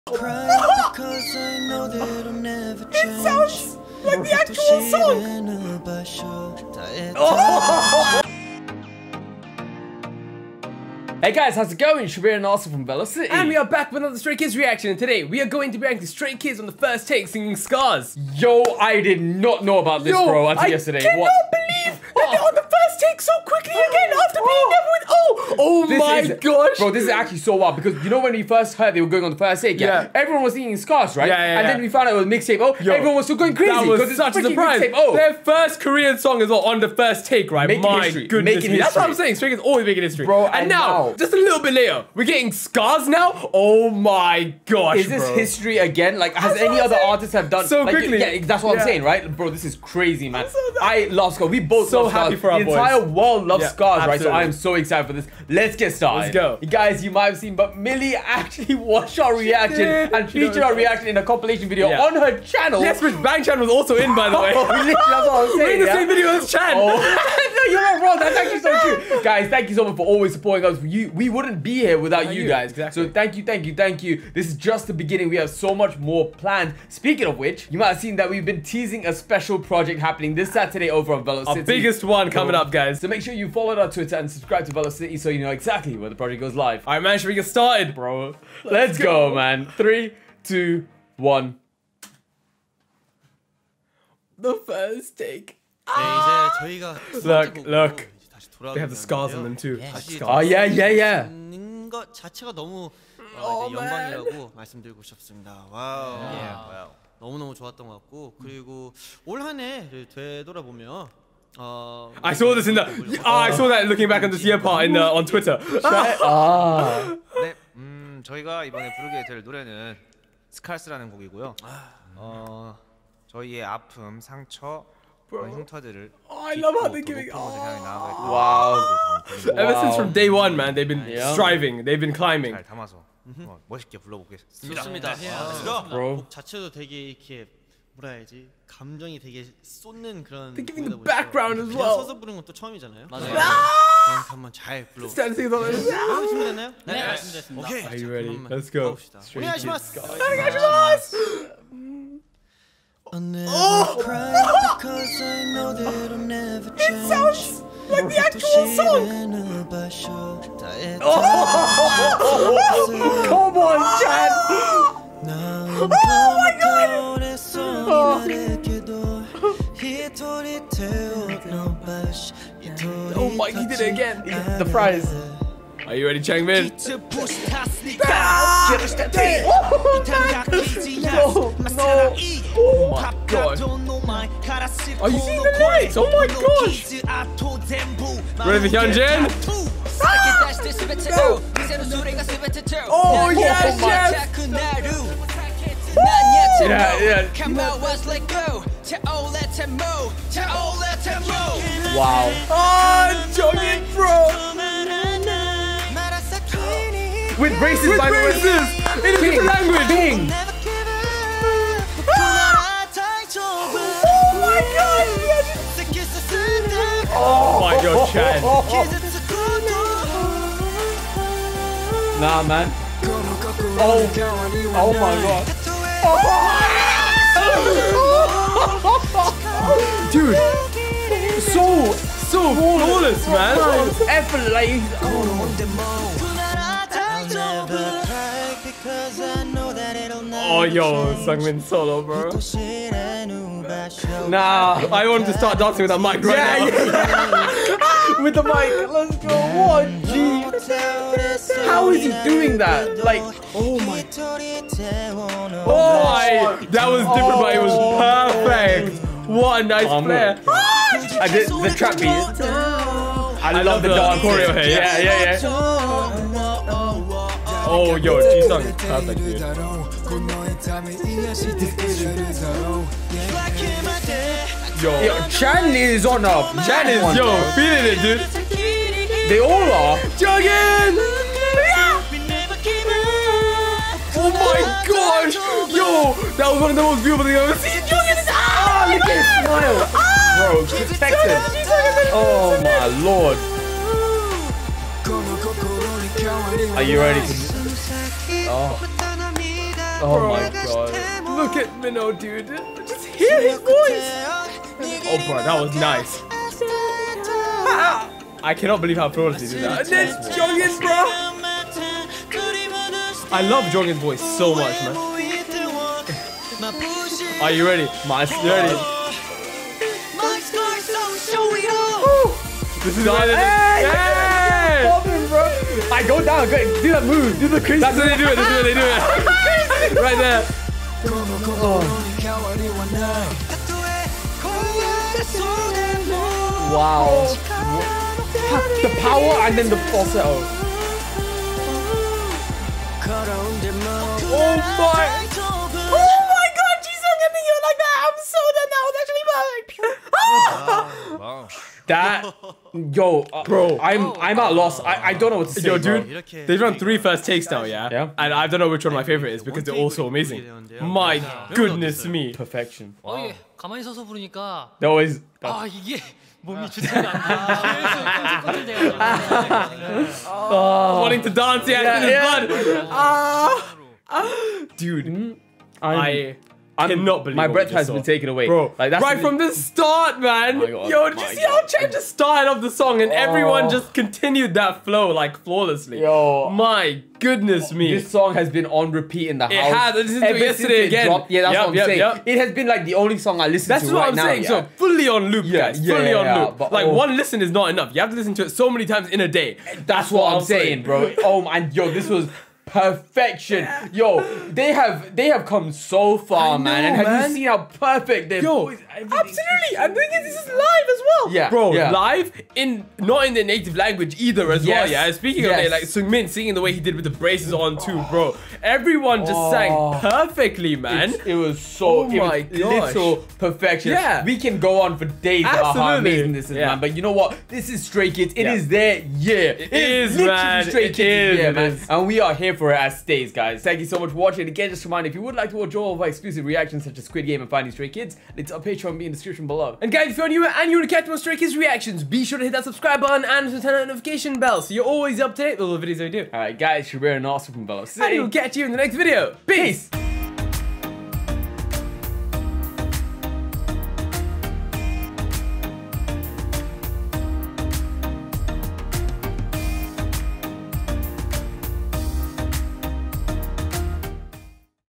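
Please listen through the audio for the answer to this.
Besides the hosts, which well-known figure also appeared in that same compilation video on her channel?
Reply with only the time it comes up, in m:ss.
1:03.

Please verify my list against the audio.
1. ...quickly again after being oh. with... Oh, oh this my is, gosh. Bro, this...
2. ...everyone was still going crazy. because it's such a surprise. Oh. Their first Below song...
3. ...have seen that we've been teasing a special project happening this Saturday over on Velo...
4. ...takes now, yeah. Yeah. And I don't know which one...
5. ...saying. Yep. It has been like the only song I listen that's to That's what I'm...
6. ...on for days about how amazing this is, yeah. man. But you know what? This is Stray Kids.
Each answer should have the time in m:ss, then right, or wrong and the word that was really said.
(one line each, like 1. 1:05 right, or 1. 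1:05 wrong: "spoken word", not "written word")
1. 0:23 right
2. 0:32 wrong: "Korean", not "Below"
3. 1:17 right
4. 5:57 right
5. 6:31 right
6. 7:04 right.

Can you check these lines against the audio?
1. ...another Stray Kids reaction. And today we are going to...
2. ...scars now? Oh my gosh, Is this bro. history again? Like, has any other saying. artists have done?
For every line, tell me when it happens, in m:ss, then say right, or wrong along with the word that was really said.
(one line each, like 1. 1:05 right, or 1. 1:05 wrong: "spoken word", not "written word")
1. 0:14 right
2. 0:42 right.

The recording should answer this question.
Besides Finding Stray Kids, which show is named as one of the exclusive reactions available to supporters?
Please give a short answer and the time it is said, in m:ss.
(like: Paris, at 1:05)
Squid Game, at 7:17.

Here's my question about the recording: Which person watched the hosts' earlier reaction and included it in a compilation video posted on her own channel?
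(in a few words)
Millie.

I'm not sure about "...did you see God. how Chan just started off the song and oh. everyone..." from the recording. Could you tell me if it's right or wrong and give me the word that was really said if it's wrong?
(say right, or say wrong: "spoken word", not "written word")
right.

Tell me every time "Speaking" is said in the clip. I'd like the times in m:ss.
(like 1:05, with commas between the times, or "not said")
1:16, 6:55.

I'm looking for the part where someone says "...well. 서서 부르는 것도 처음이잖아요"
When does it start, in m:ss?
2:21.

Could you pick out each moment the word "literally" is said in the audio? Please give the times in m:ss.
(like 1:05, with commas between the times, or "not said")
1:04.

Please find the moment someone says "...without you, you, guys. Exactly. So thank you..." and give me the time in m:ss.
1:11.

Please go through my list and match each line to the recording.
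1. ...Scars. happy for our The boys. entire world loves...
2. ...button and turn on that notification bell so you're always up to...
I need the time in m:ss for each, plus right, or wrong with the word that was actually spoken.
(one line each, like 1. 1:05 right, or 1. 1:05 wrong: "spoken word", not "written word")
1. 0:52 right
2. 7:23 right.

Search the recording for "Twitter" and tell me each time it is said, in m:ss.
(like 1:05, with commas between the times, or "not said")
1:23, 1:55.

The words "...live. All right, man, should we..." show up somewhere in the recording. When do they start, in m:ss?
1:26.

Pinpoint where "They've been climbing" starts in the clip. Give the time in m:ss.
2:11.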